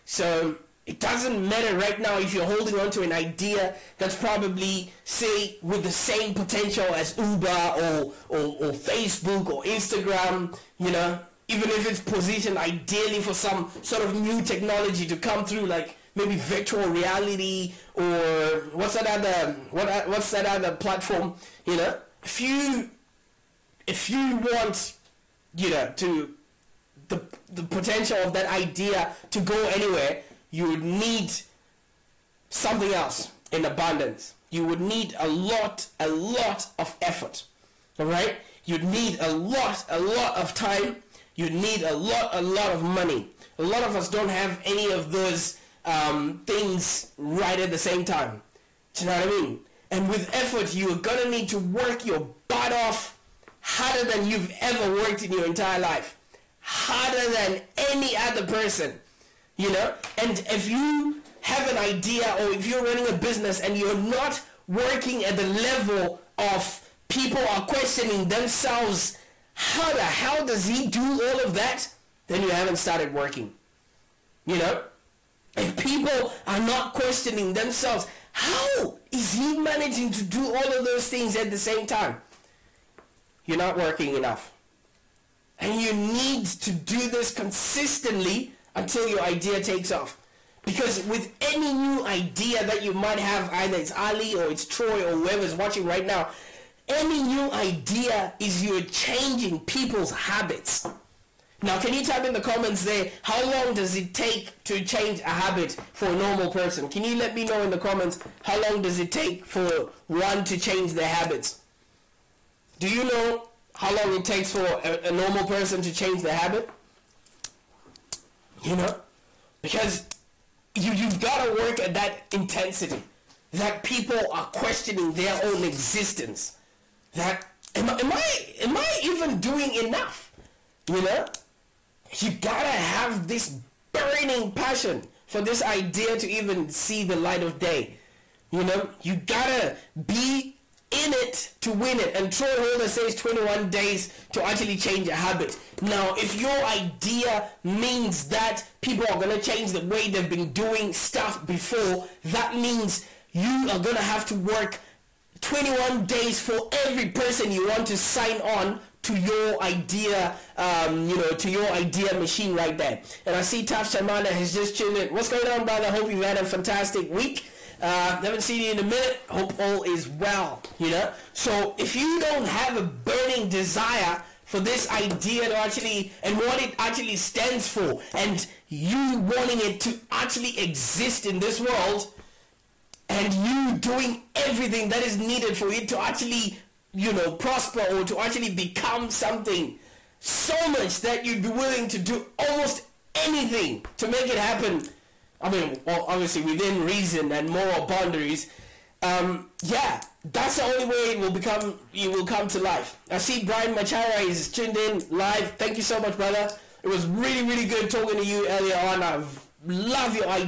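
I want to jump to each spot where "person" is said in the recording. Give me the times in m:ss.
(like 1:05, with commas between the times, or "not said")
0:58, 1:46, 1:55, 2:37.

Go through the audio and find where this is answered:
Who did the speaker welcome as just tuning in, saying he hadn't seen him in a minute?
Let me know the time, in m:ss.
2:43.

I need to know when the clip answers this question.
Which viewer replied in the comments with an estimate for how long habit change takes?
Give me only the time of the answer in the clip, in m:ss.
2:22.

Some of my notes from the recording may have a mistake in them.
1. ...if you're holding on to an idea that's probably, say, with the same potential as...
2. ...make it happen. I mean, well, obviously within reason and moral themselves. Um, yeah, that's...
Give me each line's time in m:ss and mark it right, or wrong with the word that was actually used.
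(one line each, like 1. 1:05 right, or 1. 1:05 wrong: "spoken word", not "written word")
1. 0:02 right
2. 3:14 wrong: "boundaries", not "themselves".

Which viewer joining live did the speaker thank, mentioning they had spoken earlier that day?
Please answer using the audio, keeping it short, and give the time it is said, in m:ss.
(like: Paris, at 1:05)
Brian Machara, at 3:23.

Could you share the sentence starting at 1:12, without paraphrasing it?
Then you haven't started working, you know?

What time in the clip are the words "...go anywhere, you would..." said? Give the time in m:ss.
0:29.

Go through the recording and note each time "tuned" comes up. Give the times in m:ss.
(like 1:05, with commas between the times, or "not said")
2:44, 3:24.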